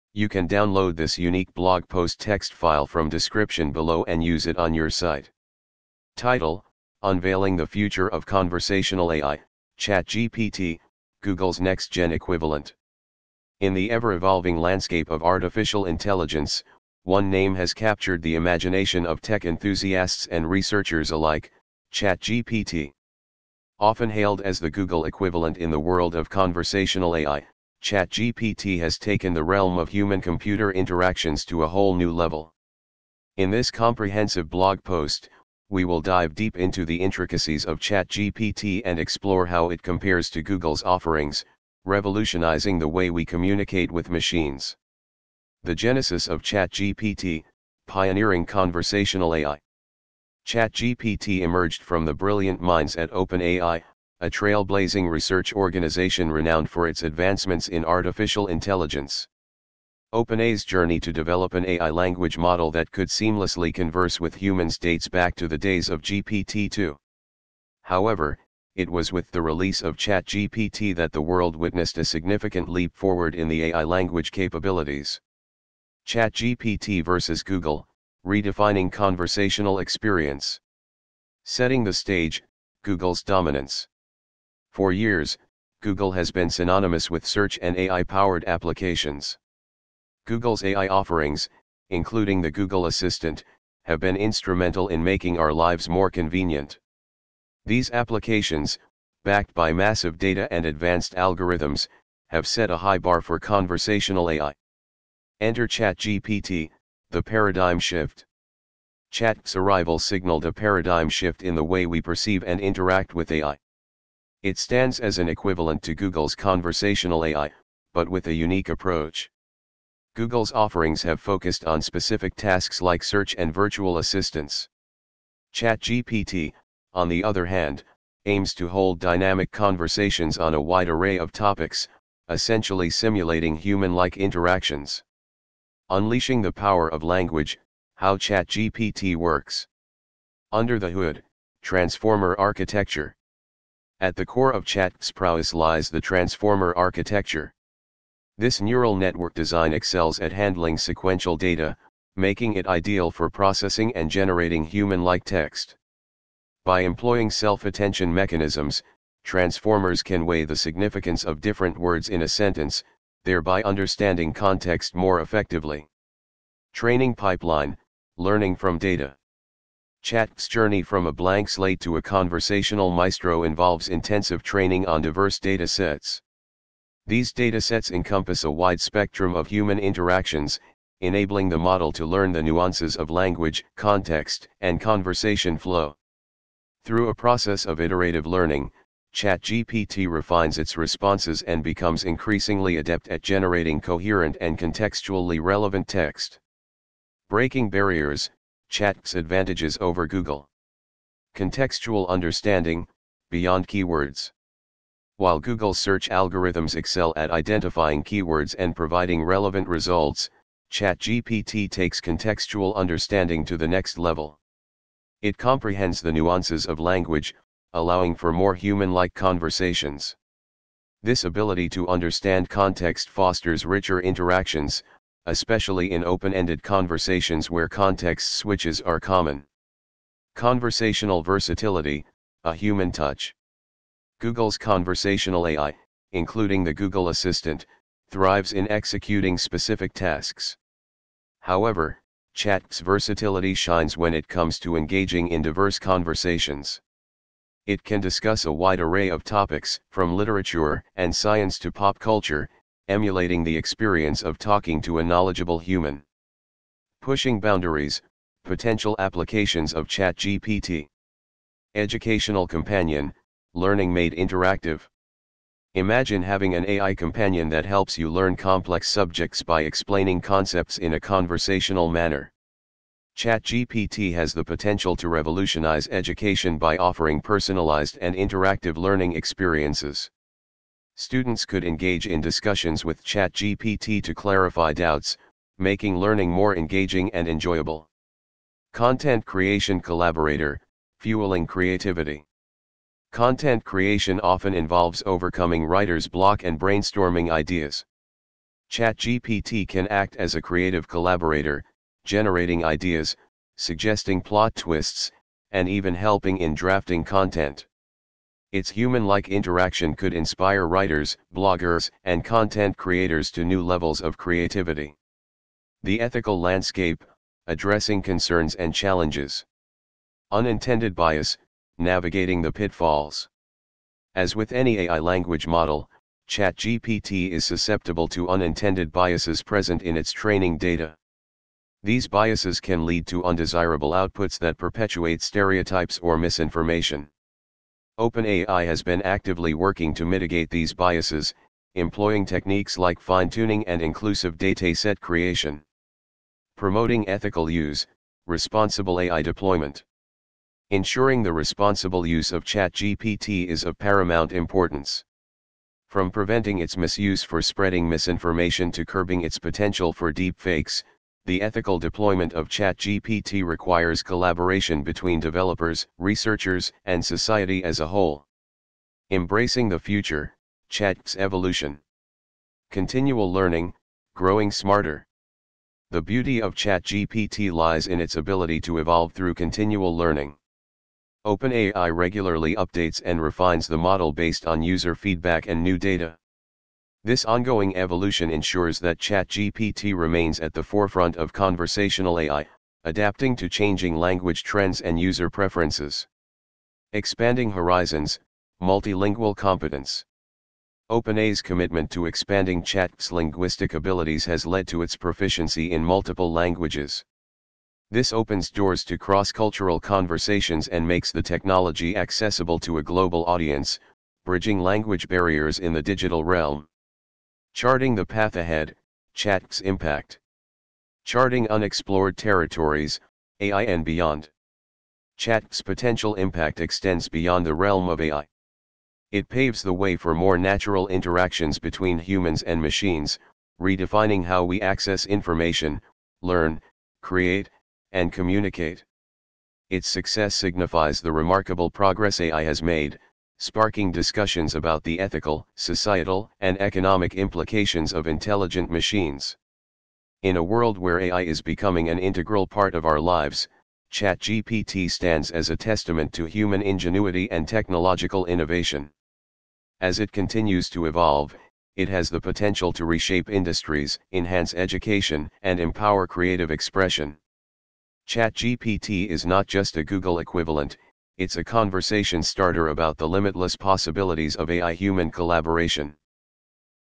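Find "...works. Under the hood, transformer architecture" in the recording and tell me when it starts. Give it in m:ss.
2:19.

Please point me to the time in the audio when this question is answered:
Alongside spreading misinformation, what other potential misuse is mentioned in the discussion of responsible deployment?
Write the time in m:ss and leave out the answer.
6:00.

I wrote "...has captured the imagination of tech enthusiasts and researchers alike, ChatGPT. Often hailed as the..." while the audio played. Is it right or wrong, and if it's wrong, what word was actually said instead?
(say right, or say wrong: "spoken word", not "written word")
right.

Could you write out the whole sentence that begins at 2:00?
Google's offerings have focused on specific tasks like search and virtual assistants.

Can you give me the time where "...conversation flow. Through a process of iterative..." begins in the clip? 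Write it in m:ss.
3:04.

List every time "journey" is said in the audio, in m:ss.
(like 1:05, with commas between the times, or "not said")
1:00, 2:50.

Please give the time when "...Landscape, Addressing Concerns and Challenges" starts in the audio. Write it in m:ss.
5:16.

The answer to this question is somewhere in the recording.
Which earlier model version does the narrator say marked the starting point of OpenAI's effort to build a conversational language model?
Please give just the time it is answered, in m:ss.
1:06.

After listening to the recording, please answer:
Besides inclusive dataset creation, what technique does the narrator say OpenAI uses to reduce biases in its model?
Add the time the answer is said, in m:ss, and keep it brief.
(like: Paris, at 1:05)
fine-tuning, at 5:42.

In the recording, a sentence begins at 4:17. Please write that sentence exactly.
Pushing boundaries, potential applications of ChatGPT.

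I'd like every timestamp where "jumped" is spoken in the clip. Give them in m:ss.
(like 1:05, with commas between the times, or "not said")
not said.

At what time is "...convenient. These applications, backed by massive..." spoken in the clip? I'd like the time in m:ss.
1:36.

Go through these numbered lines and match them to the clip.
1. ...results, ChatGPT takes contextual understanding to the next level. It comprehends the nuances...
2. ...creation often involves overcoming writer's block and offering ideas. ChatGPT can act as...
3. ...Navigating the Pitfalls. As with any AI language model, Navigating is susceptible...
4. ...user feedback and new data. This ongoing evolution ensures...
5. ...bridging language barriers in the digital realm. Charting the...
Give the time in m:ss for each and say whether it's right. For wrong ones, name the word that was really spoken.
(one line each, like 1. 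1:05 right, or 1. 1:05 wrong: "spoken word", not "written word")
1. 3:29 right
2. 4:53 wrong: "brainstorming", not "offering"
3. 5:21 wrong: "ChatGPT", not "Navigating"
4. 6:24 right
5. 6:54 right.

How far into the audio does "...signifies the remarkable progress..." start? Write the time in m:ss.
7:20.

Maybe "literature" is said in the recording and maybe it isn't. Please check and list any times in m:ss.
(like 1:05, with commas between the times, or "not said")
4:10.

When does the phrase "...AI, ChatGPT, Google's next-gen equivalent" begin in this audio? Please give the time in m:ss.
0:09.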